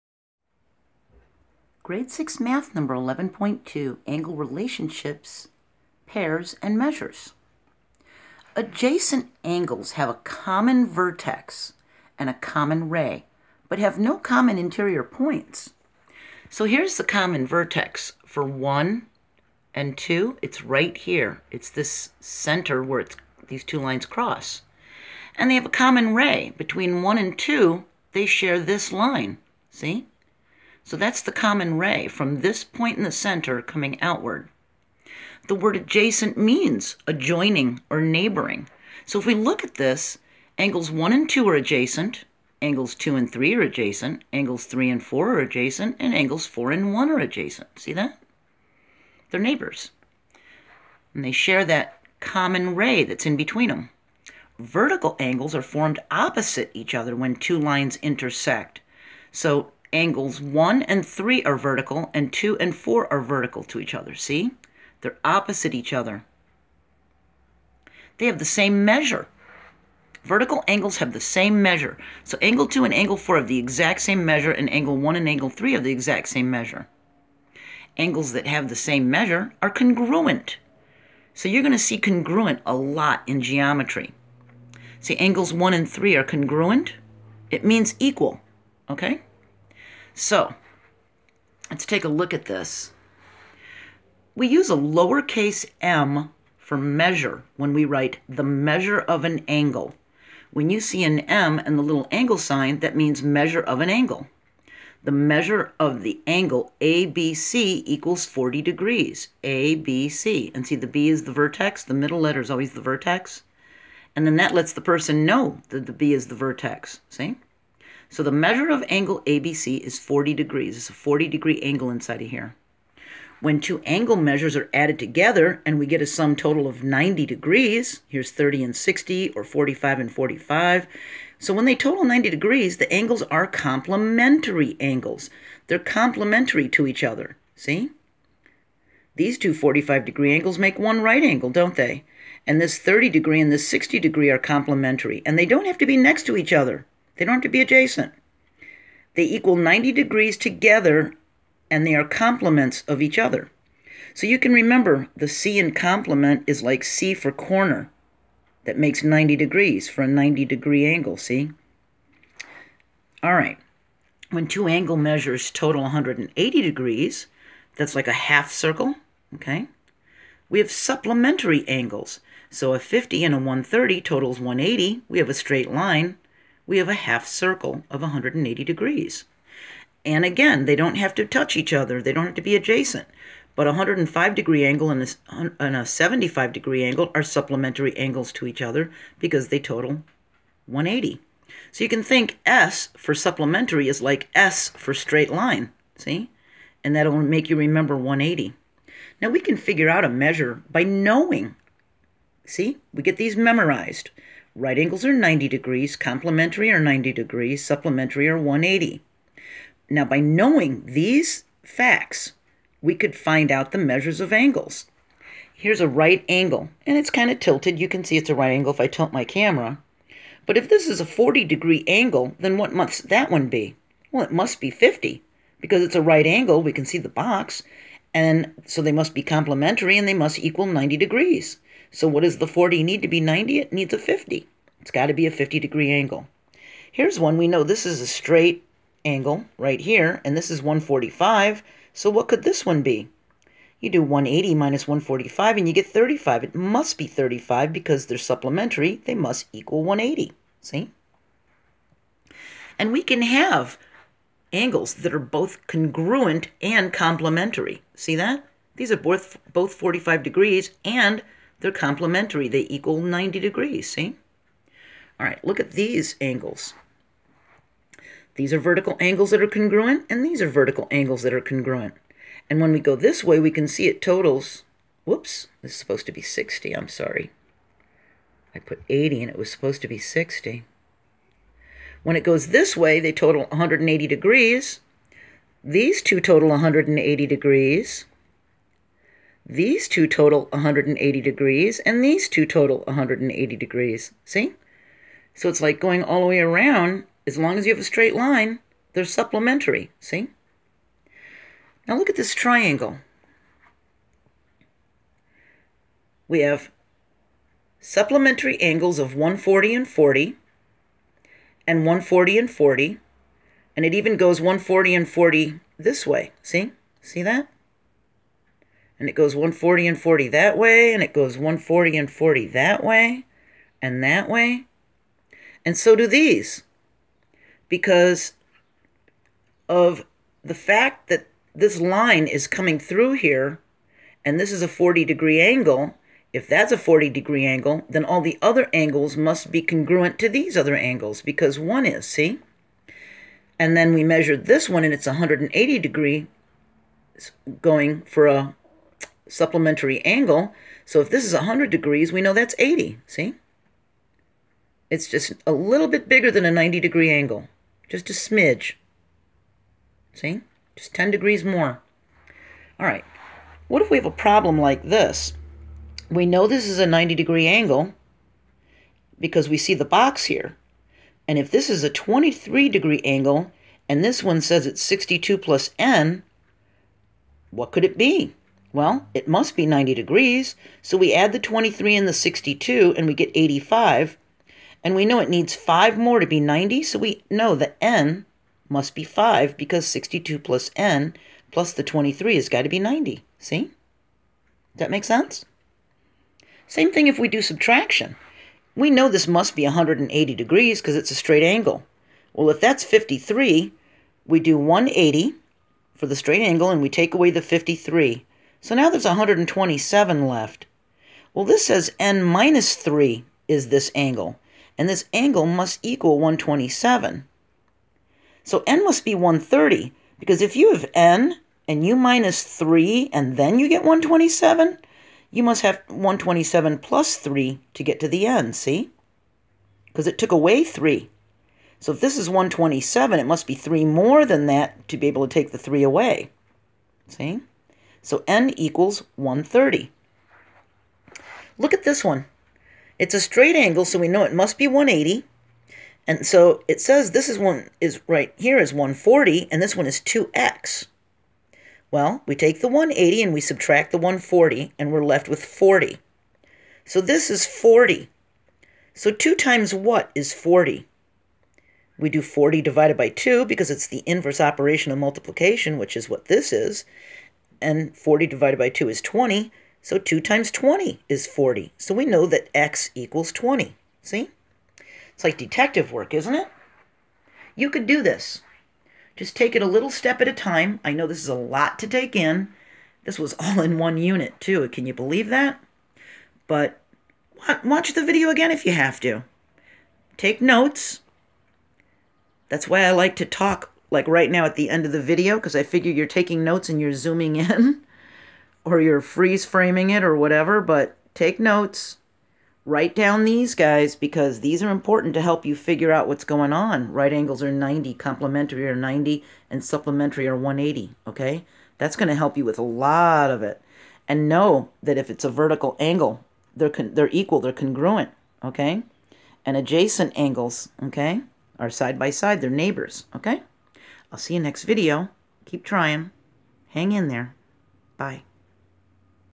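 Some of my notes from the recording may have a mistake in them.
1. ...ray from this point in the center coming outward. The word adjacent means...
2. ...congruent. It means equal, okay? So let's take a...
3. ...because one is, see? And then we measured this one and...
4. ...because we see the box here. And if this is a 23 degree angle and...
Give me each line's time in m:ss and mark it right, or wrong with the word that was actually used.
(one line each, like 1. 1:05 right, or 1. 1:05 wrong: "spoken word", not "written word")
1. 0:31 right
2. 1:26 right
3. 5:41 right
4. 6:09 right.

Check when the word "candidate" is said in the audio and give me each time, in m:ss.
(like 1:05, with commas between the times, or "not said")
not said.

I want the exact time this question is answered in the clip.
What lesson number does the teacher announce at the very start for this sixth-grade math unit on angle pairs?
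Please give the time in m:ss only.
0:02.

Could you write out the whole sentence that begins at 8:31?
That's going to help you with a lot of it.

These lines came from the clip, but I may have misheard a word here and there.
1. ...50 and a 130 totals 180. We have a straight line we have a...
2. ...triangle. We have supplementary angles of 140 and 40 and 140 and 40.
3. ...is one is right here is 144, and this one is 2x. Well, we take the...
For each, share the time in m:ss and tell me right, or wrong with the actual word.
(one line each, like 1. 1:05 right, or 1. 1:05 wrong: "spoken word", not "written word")
1. 2:52 right
2. 5:02 right
3. 7:27 wrong: "140", not "144".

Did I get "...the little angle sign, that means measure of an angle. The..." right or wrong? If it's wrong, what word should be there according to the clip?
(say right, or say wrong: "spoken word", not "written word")
right.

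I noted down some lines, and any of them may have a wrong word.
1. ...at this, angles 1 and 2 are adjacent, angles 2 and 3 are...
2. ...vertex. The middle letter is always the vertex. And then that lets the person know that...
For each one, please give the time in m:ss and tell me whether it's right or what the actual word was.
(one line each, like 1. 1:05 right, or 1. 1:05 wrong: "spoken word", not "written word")
1. 0:39 right
2. 1:51 right.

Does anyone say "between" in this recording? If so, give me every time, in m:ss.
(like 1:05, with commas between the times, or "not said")
0:26, 0:53.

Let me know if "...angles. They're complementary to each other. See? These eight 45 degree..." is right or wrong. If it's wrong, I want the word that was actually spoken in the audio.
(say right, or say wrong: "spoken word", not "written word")
wrong: "two", not "eight".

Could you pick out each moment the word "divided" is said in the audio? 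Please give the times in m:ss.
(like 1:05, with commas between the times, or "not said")
7:42, 7:48.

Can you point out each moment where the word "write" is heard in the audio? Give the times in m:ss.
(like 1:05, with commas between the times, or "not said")
1:37, 8:22.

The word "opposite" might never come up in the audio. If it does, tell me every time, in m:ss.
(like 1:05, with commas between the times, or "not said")
0:56, 1:05.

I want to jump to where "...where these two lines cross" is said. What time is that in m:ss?
0:22.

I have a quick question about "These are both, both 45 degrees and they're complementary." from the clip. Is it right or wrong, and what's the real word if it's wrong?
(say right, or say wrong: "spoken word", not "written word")
right.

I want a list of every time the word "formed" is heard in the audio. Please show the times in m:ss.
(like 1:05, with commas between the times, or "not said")
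0:55.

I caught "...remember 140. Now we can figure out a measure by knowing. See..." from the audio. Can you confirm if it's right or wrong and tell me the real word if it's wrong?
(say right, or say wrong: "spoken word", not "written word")
wrong: "180", not "140".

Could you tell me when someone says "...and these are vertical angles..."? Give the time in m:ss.
4:30.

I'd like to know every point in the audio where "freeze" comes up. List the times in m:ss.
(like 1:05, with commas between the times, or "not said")
8:19.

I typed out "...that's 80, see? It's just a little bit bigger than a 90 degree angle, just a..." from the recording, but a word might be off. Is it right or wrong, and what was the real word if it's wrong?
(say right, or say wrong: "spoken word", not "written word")
right.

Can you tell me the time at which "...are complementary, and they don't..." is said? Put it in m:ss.
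2:24.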